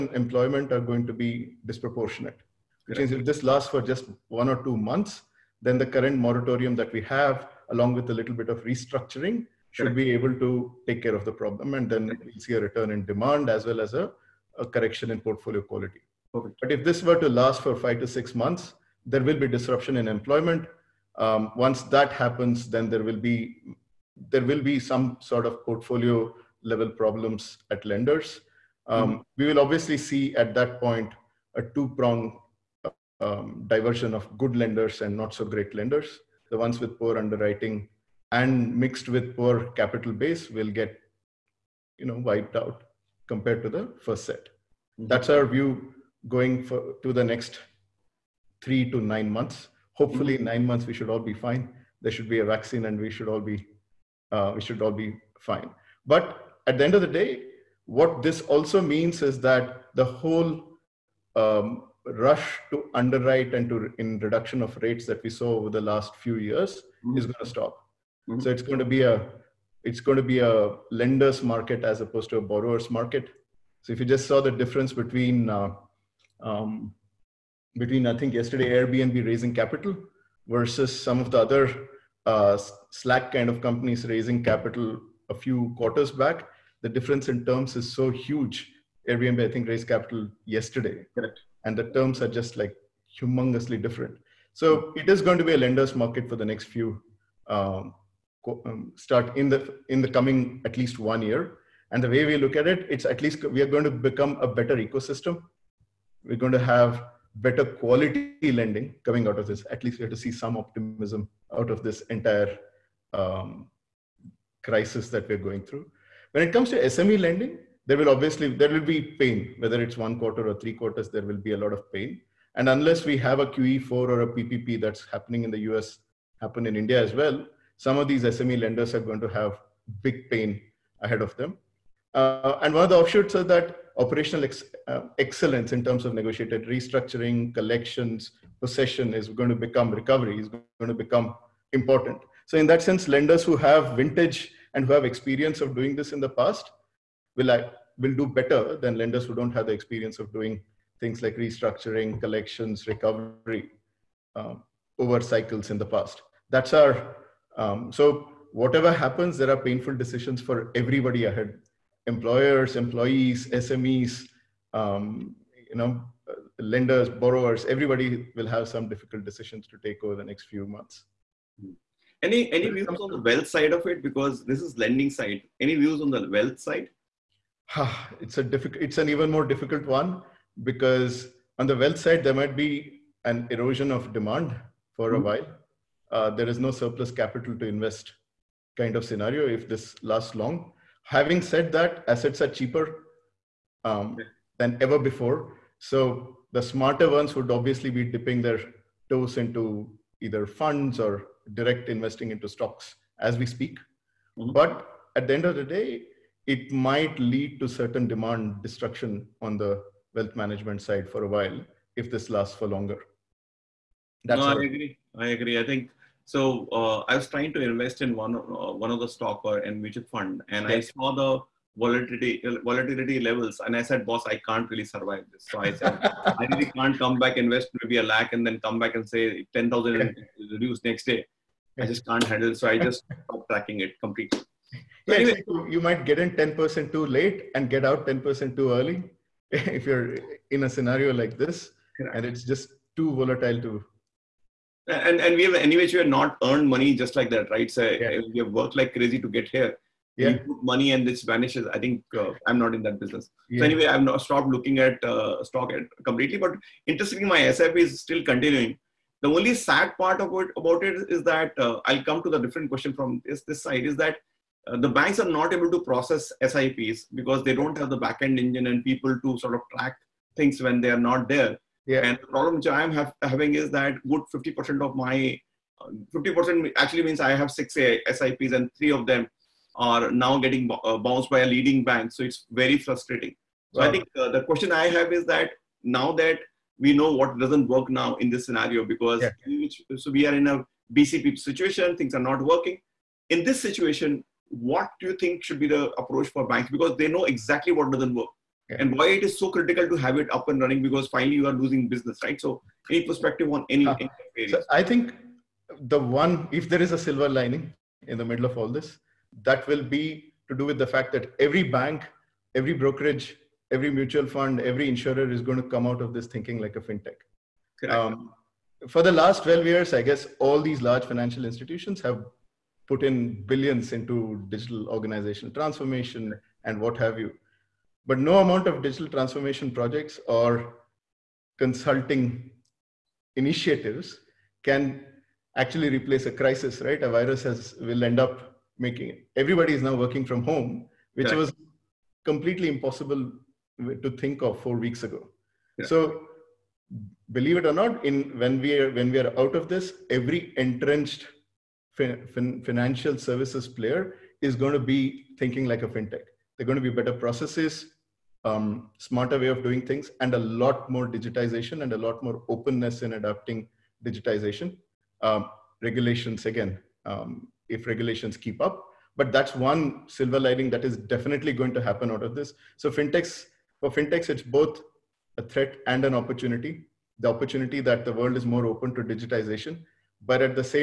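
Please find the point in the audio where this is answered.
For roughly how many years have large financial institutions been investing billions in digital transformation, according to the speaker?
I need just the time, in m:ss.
5:19.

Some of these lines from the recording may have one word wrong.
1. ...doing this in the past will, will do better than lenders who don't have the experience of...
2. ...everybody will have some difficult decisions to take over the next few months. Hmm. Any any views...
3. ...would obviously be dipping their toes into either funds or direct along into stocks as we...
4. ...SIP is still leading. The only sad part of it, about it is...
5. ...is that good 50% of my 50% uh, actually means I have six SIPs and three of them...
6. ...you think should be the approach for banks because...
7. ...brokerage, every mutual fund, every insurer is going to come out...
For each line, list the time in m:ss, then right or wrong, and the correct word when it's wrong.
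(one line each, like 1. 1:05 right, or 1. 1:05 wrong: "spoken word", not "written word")
1. 2:25 right
2. 2:47 right
3. 3:17 wrong: "investing", not "along"
4. 4:17 wrong: "continuing", not "leading"
5. 4:33 right
6. 4:55 right
7. 5:12 right.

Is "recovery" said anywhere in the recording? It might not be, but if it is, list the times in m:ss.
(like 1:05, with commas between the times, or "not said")
2:19, 2:32.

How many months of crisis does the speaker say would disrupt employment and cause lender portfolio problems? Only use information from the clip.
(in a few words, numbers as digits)
5 to 6 months.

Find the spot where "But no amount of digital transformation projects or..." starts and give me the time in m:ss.
5:28.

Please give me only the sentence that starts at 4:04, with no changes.
And and we have anyways we have not earned money just like that, right?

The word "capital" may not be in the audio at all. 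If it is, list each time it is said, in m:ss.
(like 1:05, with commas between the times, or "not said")
0:39, 1:19, 1:24, 1:29, 3:07.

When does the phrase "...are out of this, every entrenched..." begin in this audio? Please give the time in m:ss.
5:49.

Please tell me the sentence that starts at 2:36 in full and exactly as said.
That's our, um, so whatever happens, there are painful decisions for everybody ahead.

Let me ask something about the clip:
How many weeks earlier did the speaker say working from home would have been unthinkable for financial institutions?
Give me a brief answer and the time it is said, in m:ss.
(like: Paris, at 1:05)
4 weeks, at 5:44.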